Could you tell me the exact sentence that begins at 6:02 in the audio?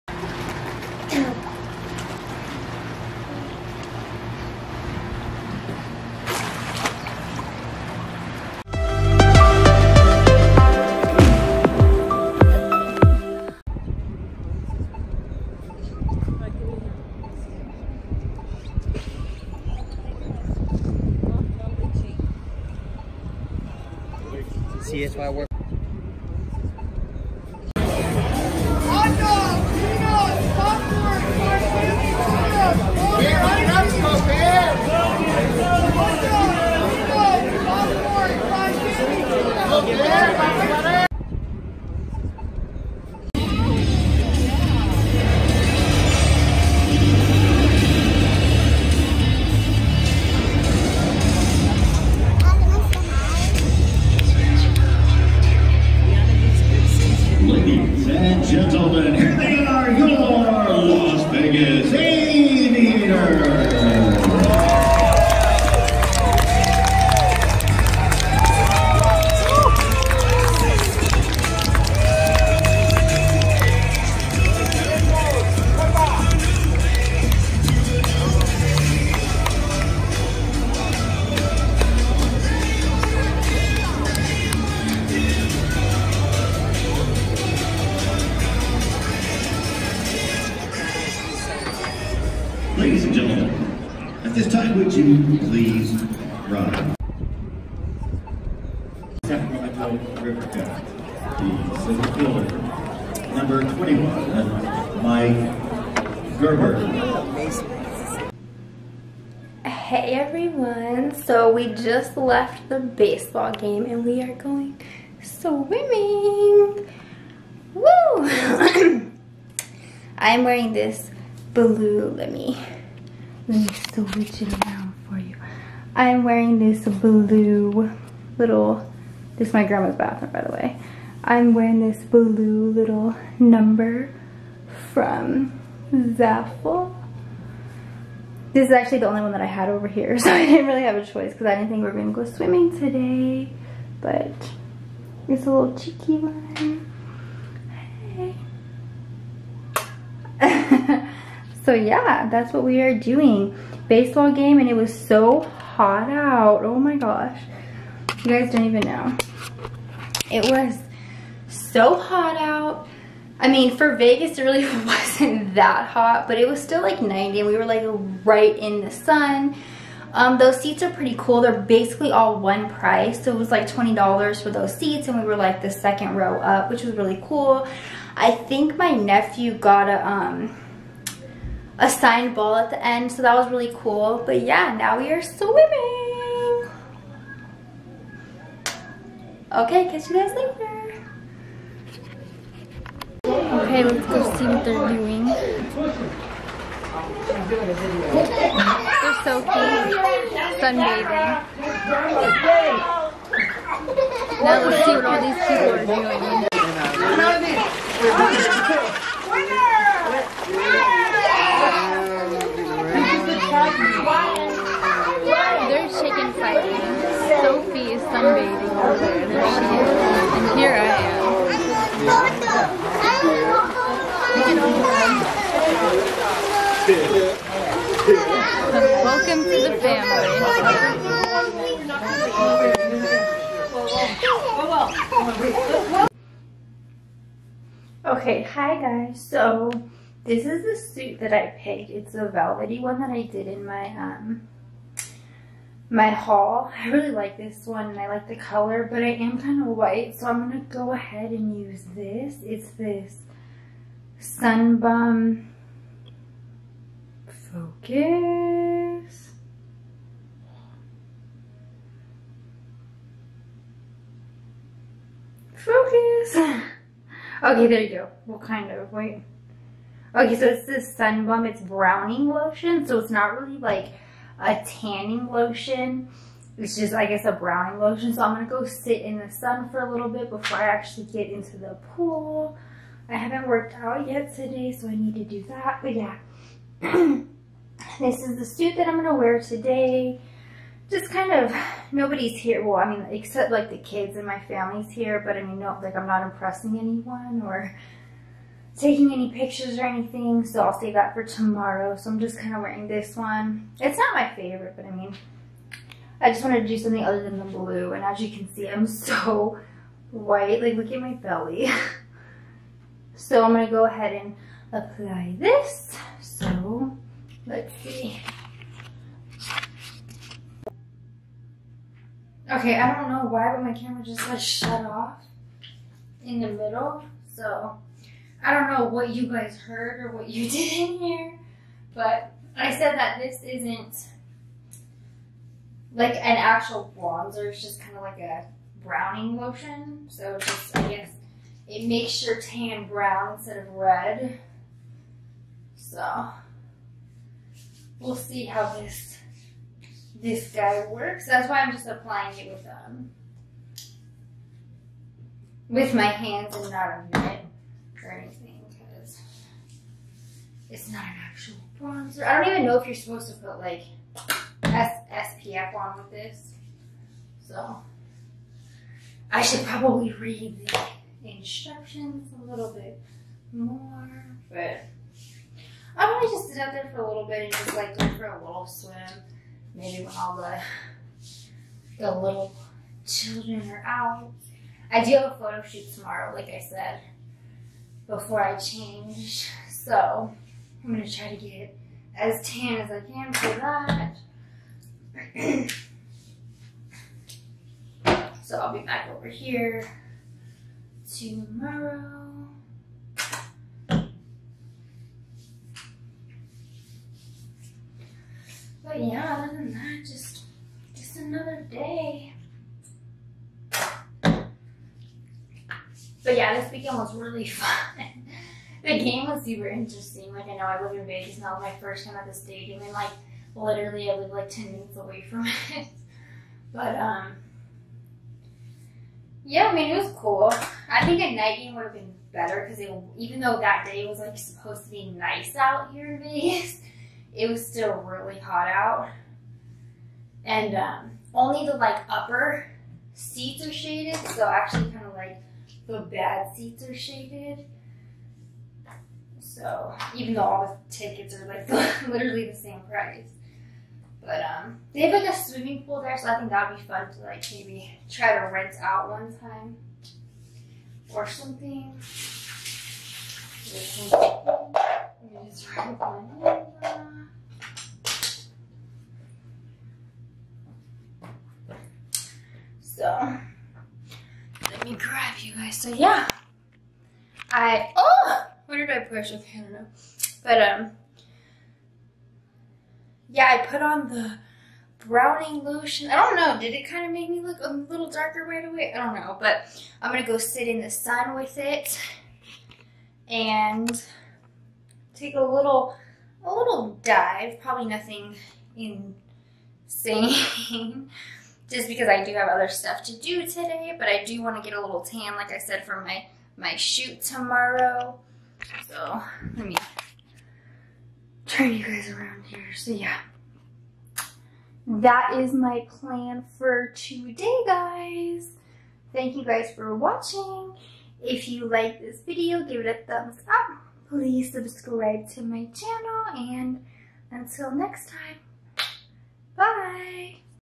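I don't even know if you're supposed to put like S SPF on with this.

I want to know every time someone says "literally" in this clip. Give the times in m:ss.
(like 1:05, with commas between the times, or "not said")
7:03, 7:32.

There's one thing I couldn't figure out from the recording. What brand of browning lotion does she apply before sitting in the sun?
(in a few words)
Sun Bum.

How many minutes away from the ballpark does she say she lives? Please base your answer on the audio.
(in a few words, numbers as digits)
10.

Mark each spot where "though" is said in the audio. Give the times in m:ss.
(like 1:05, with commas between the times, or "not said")
7:13, 7:30.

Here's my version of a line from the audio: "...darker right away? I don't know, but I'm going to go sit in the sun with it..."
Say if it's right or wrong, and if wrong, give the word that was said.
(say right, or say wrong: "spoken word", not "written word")
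right.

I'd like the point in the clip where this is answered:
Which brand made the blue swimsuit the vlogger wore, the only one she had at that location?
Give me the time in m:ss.
2:16.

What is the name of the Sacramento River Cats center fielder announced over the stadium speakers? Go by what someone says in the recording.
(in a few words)
Mike Gerber.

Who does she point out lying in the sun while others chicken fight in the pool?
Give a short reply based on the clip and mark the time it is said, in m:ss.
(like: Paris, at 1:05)
Sophie, at 3:37.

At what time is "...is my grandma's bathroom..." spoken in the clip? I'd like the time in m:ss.
2:09.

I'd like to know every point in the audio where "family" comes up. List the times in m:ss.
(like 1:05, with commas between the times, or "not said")
3:49, 4:54.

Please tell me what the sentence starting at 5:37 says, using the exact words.
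It's just kind of like a browning lotion.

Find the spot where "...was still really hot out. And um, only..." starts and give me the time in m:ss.
7:17.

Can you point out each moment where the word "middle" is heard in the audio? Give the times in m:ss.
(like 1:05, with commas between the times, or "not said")
5:26.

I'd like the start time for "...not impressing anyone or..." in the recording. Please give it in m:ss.
4:56.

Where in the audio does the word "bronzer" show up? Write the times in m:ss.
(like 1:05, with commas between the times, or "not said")
5:36, 6:01.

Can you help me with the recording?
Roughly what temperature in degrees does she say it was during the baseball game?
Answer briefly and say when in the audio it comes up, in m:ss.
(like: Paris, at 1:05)
90, at 2:47.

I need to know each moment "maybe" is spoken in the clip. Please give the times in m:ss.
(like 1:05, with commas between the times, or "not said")
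6:19, 7:37.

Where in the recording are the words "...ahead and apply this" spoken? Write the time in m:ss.
5:13.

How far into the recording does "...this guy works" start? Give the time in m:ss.
5:50.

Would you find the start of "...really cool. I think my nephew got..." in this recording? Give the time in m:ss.
2:56.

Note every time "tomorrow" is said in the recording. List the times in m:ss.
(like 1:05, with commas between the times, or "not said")
5:01, 6:25, 6:41, 8:27.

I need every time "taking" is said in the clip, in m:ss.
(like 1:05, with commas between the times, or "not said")
4:58.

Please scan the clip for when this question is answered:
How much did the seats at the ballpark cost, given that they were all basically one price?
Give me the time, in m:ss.
2:53.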